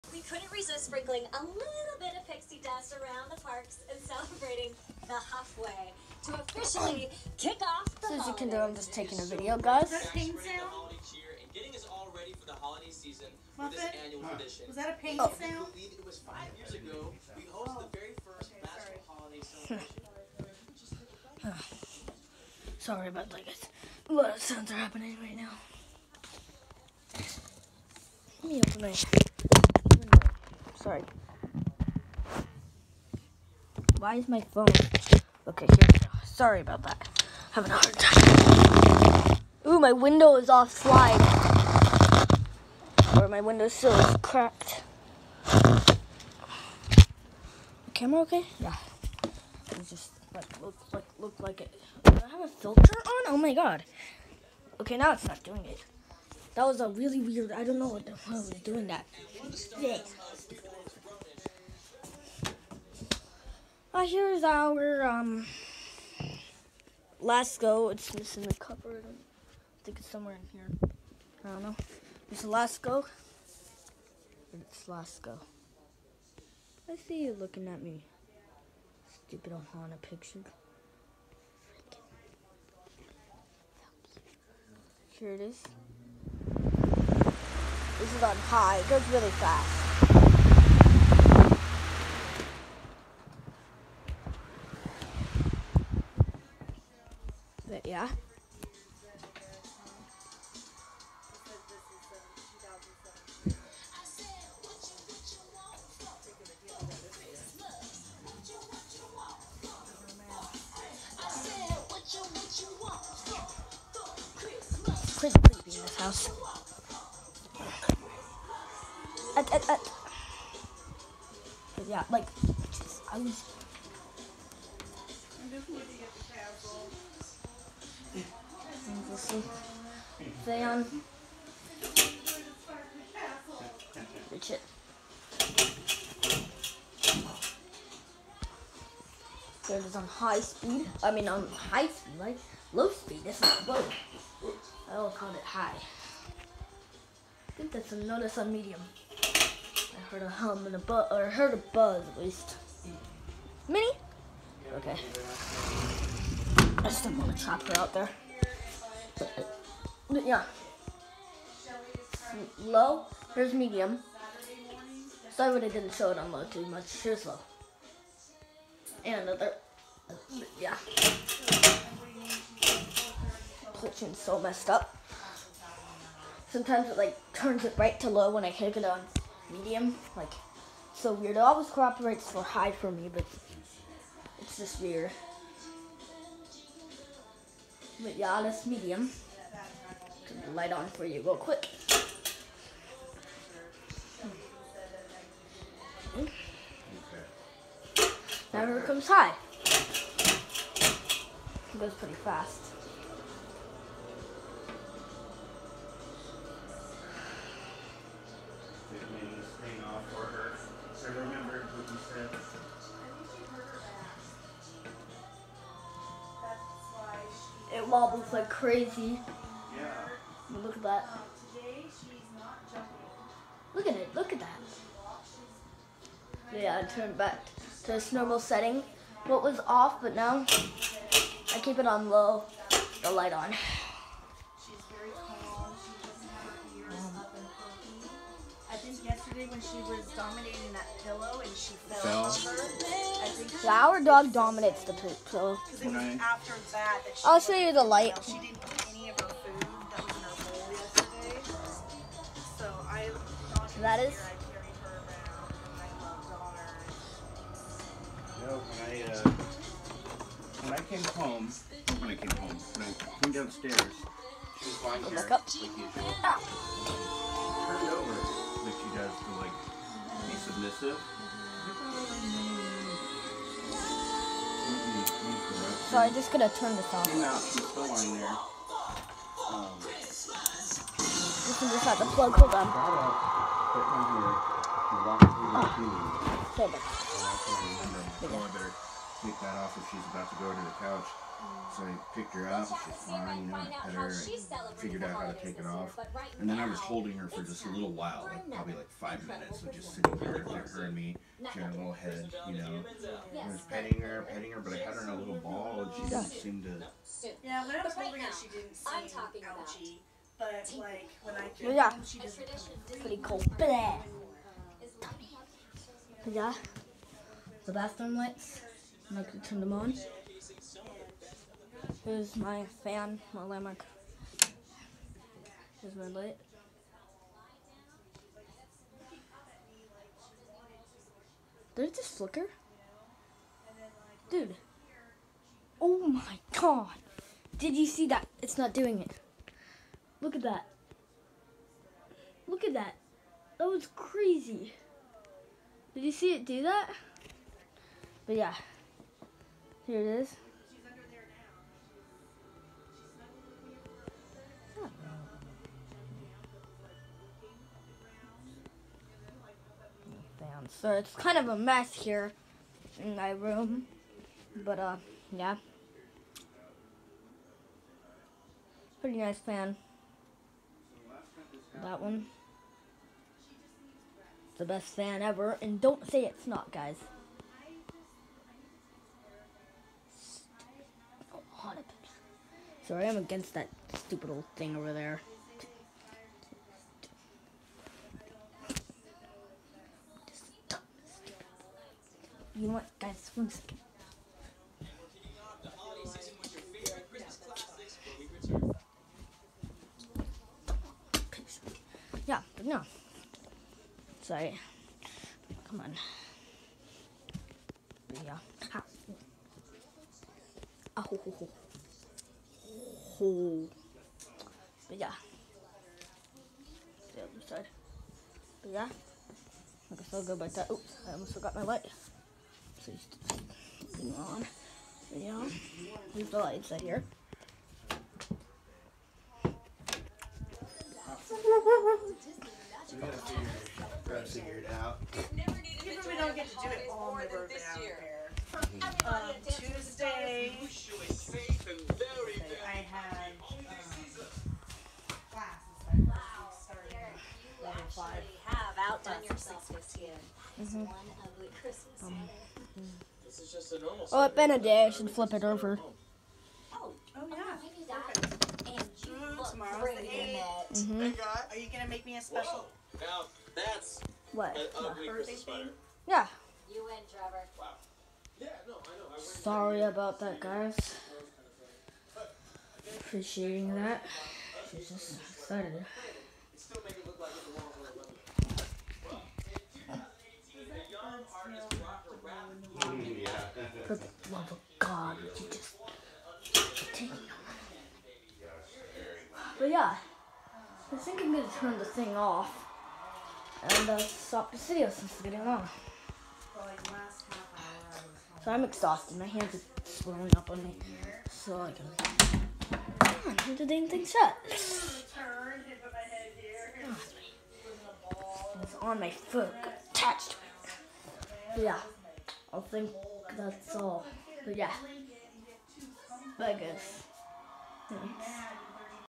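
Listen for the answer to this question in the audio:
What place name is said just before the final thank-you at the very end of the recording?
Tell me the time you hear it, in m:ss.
8:36.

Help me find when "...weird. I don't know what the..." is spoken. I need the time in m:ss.
0:57.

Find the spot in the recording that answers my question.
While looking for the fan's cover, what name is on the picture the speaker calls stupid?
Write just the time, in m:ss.
1:19.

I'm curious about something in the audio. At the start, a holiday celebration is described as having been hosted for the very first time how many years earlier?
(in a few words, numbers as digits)
5 years.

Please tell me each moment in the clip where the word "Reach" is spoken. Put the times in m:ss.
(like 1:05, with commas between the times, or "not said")
2:14.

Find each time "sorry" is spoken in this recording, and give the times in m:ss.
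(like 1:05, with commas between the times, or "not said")
0:22, 0:30, 0:36, 2:45, 6:22, 6:44, 7:49.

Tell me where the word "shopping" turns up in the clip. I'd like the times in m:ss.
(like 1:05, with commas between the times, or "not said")
not said.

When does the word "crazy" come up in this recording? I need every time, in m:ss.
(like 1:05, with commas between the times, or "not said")
3:38, 5:43.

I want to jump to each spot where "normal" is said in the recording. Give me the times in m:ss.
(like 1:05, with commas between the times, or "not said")
3:48, 7:33.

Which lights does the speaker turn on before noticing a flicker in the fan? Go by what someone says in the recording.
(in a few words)
Bathroom lights.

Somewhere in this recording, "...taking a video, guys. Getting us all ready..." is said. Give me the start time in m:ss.
0:08.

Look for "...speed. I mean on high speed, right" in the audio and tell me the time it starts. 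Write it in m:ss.
2:20.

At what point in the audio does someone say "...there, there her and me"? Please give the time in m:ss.
5:00.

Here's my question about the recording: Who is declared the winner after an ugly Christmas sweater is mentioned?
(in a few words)
Trevor.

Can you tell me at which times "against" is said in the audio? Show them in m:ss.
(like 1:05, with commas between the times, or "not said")
6:23.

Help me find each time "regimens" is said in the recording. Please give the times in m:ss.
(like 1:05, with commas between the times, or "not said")
not said.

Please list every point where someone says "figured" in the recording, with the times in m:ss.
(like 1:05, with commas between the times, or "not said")
4:54.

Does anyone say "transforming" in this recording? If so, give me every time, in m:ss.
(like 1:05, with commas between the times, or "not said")
not said.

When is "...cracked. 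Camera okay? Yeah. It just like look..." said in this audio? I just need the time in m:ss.
0:44.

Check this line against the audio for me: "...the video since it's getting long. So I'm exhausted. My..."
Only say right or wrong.
right.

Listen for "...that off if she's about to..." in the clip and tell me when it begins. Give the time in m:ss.
4:49.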